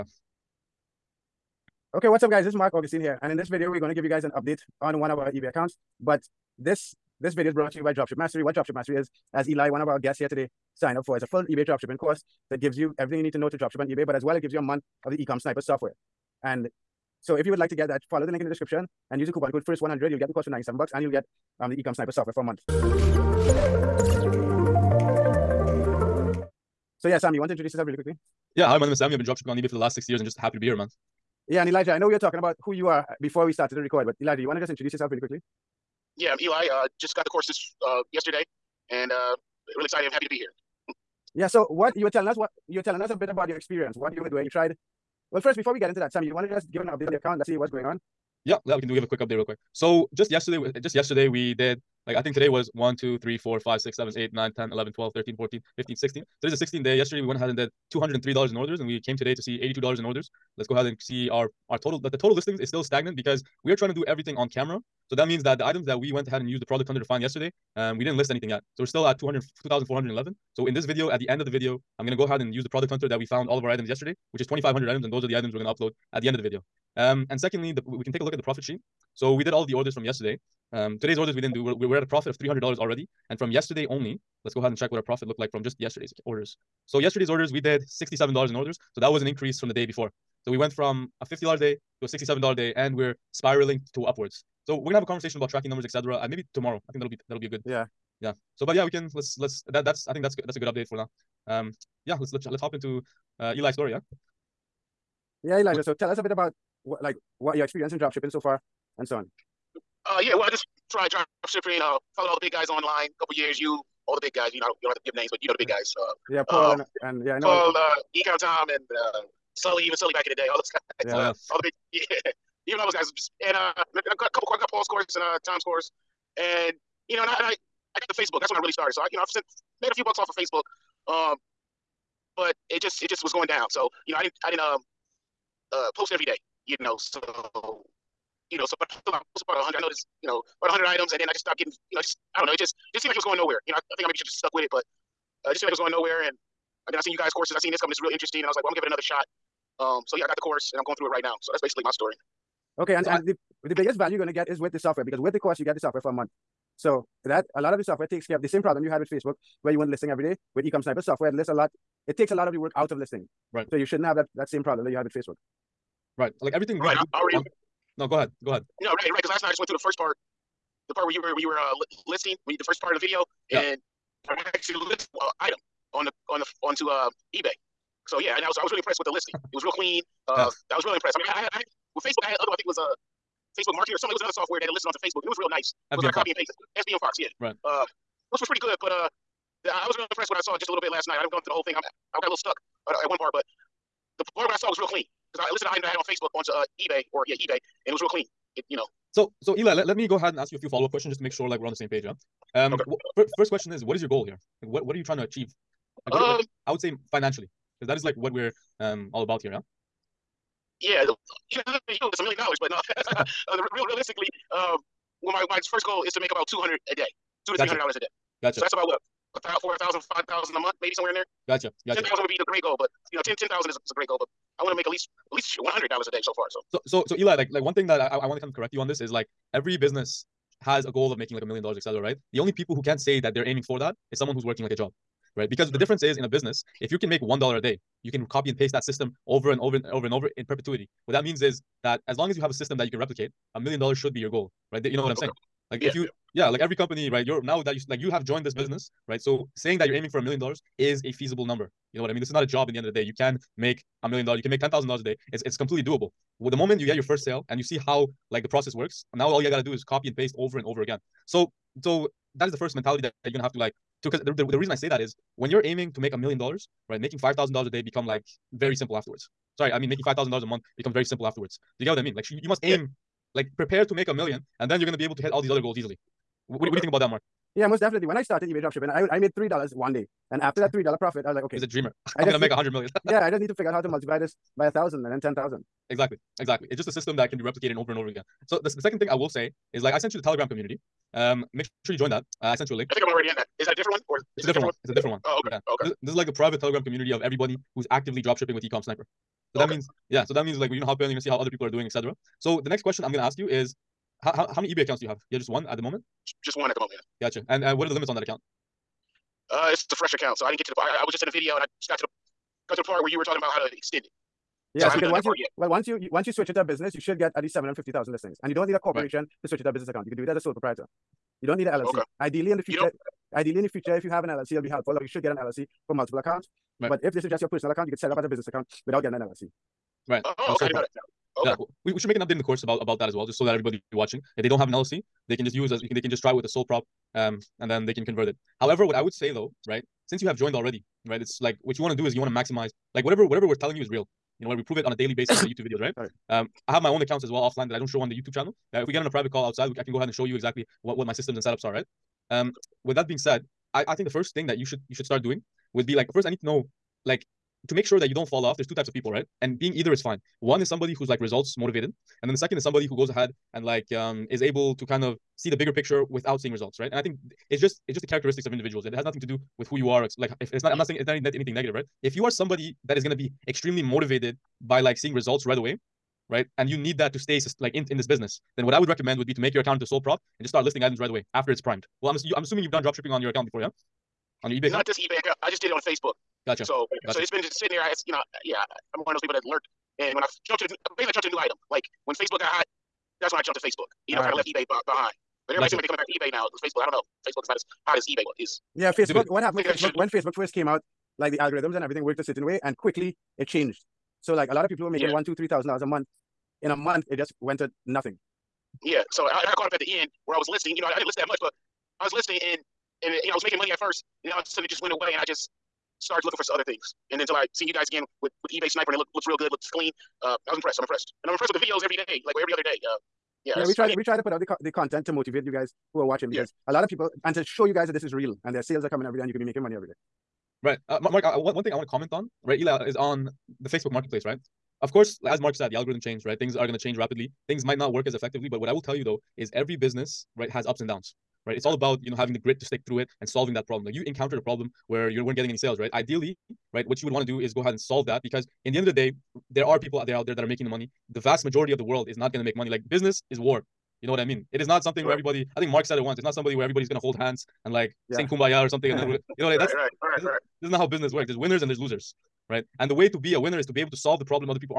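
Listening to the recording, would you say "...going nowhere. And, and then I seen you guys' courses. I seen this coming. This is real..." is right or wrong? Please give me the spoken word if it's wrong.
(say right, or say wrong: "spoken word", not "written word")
right.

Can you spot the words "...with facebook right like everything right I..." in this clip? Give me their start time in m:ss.
2:45.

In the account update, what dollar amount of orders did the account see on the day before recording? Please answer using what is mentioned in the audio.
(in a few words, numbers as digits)
$203.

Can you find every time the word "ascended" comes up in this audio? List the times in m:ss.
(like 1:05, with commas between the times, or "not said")
not said.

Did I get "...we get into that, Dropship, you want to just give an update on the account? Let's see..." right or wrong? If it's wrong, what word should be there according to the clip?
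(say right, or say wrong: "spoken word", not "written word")
wrong: "Sammy", not "Dropship".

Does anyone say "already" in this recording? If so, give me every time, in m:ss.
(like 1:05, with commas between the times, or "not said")
1:22, 2:47, 4:53, 5:40.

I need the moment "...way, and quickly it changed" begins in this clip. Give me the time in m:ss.
6:42.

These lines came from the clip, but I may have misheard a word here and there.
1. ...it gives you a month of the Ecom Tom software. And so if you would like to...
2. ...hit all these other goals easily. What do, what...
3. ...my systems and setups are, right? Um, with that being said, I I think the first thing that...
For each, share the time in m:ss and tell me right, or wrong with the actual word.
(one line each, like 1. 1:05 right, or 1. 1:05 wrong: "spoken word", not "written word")
1. 0:14 wrong: "Sniper", not "Tom"
2. 4:35 right
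3. 5:51 right.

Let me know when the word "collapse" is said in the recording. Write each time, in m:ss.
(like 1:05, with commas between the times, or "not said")
not said.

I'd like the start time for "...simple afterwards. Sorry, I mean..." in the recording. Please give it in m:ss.
4:28.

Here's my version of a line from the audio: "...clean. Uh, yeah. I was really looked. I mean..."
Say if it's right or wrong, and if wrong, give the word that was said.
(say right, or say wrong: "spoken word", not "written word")
wrong: "impressed", not "looked".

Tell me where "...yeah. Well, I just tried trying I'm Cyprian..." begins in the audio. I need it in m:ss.
1:50.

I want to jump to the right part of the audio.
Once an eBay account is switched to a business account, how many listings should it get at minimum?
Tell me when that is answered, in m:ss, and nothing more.
5:17.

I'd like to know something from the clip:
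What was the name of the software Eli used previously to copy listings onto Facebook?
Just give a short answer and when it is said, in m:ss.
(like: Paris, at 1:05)
SBM Fox, at 3:06.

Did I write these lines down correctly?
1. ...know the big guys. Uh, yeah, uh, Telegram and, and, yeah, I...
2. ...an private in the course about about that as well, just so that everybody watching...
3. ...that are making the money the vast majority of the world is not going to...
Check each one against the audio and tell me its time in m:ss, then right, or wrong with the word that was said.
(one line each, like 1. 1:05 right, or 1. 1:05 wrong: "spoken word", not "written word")
1. 1:55 wrong: "Paul", not "Telegram"
2. 5:32 wrong: "update", not "private"
3. 7:30 right.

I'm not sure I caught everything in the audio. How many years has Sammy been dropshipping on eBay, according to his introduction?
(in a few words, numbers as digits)
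6.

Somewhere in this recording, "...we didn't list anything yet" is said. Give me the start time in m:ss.
1:07.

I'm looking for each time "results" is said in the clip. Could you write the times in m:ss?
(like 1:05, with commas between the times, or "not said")
6:01, 6:06, 6:15.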